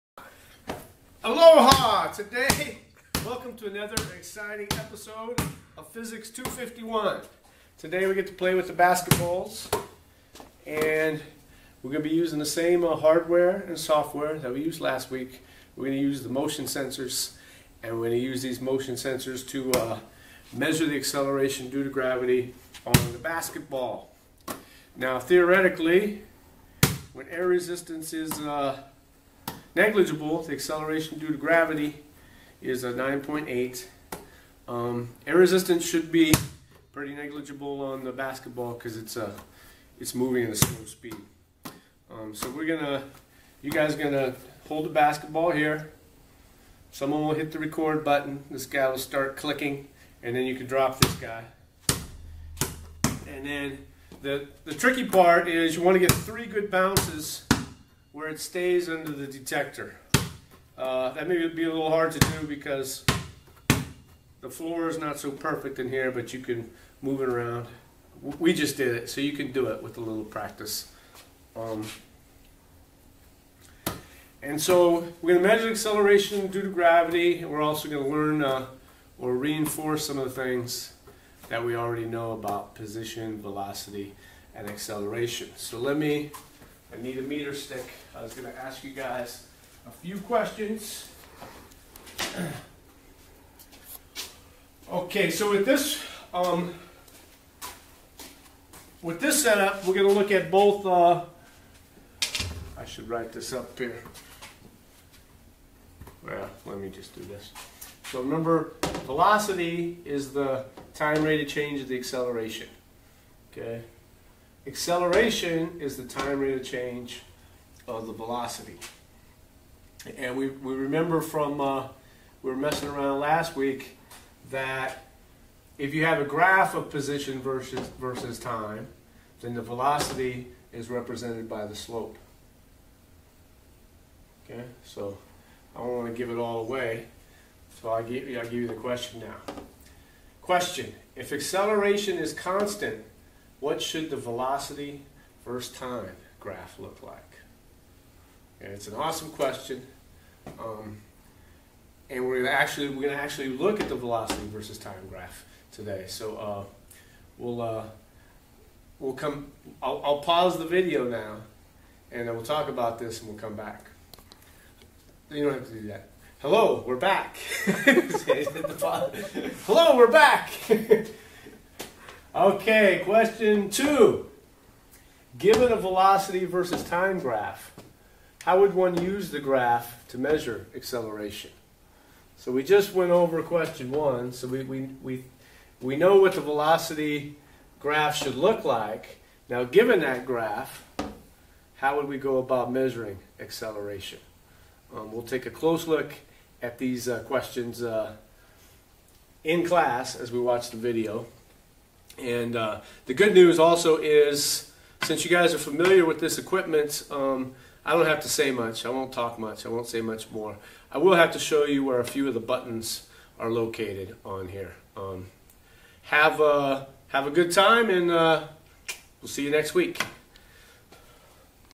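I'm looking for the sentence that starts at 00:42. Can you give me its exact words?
Um, so we're gonna, you guys gonna hold the basketball here.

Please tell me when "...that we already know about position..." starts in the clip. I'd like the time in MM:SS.
01:21.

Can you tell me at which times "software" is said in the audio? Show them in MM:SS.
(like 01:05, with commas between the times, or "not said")
00:13.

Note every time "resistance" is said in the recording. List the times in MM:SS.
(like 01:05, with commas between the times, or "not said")
00:27, 00:35.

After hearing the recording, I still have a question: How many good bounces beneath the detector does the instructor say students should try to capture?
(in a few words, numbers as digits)
3.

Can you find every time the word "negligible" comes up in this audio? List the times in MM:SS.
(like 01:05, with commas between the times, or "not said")
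00:29, 00:37.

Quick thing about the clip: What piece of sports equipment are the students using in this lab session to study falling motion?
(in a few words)
basketballs.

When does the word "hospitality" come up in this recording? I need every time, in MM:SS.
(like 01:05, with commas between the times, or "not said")
not said.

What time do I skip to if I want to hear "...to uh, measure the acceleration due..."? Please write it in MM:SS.
00:19.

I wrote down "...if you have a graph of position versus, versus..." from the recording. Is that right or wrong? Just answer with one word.
right.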